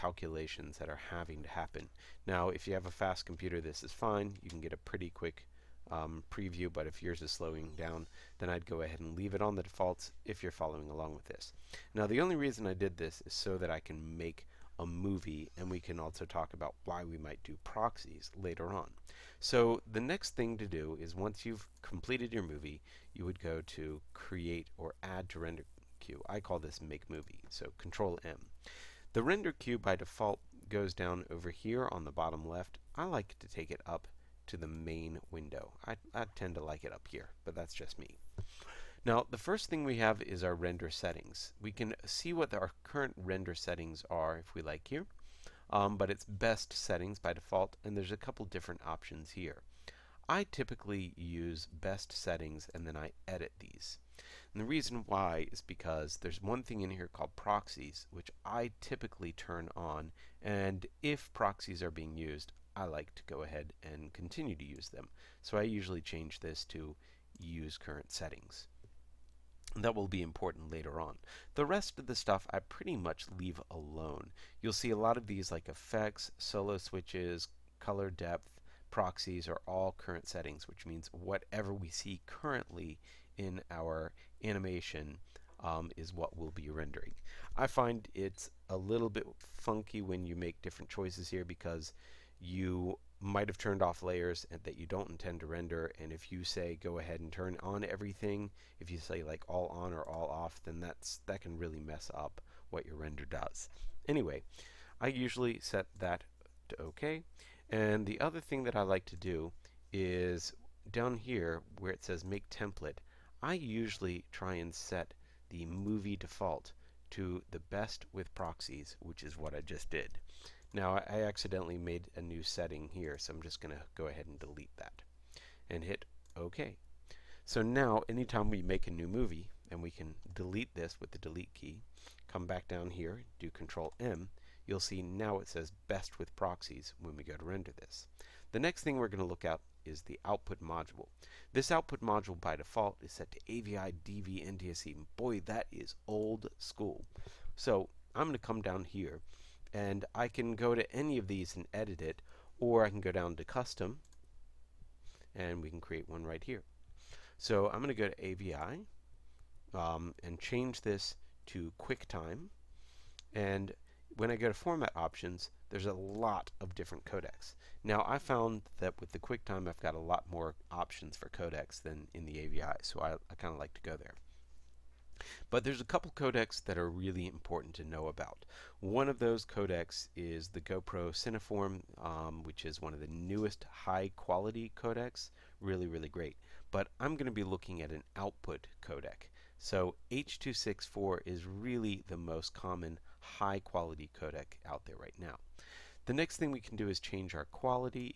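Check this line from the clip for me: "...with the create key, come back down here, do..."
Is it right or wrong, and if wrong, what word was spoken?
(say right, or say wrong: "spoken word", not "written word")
wrong: "delete", not "create".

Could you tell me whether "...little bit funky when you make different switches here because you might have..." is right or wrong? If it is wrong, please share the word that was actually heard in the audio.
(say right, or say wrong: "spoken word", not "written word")
wrong: "choices", not "switches".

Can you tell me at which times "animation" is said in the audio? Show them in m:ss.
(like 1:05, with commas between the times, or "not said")
1:24.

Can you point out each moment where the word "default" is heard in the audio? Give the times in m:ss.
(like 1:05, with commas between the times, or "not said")
0:09, 0:29, 0:47, 1:56, 2:22.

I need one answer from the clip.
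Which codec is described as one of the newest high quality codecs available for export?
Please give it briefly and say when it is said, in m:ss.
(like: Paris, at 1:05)
GoPro Cineform, at 3:00.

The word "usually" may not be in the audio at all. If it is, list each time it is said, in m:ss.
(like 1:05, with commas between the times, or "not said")
1:05, 1:45, 1:53.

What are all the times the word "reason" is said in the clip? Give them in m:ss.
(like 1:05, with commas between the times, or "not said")
0:12, 0:54.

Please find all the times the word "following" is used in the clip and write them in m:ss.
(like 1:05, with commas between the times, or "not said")
0:10.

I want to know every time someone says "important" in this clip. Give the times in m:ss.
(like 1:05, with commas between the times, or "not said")
1:10, 2:57.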